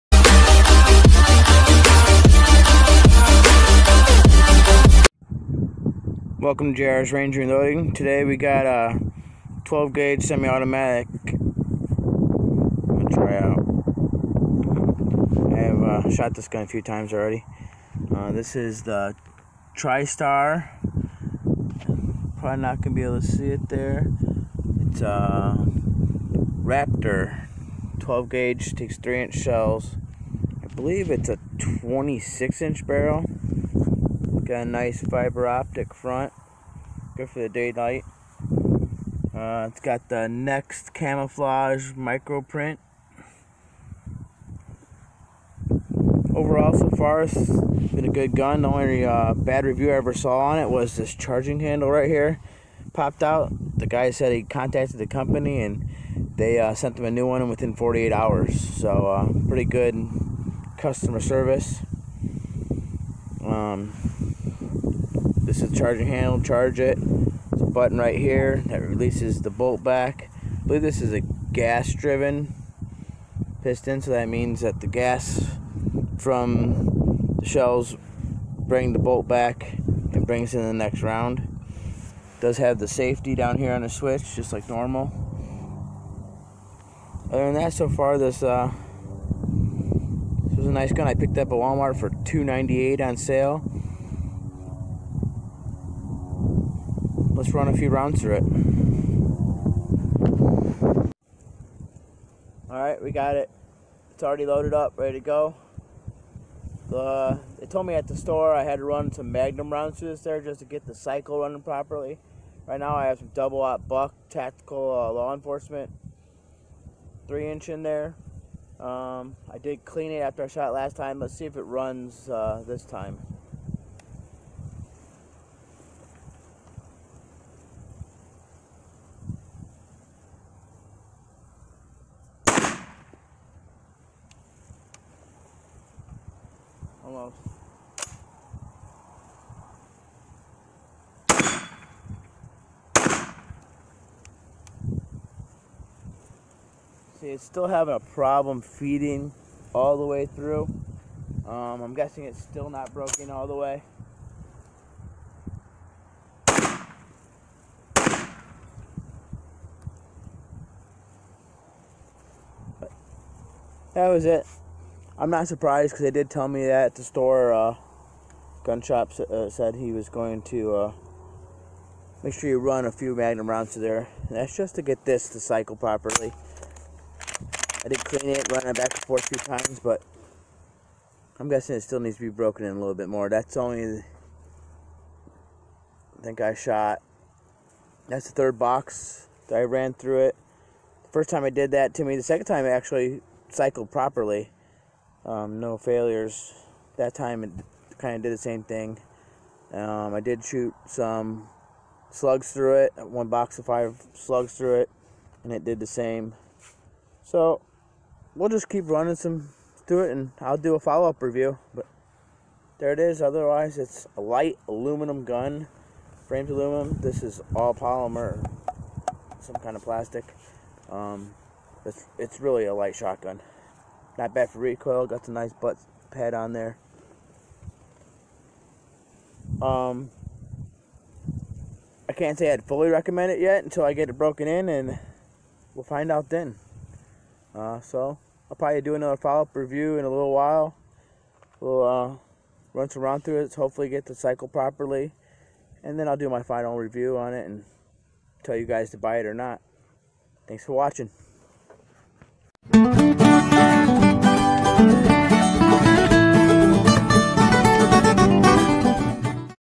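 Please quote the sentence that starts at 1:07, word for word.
There's a button right here that releases the bolt back.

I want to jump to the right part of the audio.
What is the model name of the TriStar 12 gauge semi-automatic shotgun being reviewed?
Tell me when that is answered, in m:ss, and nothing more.
0:25.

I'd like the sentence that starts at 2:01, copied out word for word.
Let's see if it runs uh, this time.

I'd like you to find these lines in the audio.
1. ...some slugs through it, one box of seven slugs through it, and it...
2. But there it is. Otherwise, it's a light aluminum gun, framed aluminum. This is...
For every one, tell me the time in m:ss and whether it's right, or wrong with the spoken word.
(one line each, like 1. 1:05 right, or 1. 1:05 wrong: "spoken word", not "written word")
1. 3:20 wrong: "five", not "seven"
2. 3:31 right.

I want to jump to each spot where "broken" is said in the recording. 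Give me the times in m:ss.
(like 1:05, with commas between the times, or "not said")
2:32, 3:02, 3:54.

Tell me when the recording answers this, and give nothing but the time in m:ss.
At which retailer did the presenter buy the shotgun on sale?
1:31.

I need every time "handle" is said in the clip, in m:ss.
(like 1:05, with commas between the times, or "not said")
0:51, 1:06.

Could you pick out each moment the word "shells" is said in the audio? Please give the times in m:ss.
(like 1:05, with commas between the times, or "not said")
0:29, 1:17.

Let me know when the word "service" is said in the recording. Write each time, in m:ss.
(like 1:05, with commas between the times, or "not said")
1:01.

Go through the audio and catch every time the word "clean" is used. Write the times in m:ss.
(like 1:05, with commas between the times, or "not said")
1:59, 2:58.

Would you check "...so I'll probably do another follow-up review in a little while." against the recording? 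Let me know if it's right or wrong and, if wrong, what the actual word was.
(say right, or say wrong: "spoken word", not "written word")
right.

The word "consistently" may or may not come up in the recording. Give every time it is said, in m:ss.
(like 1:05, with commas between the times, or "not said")
not said.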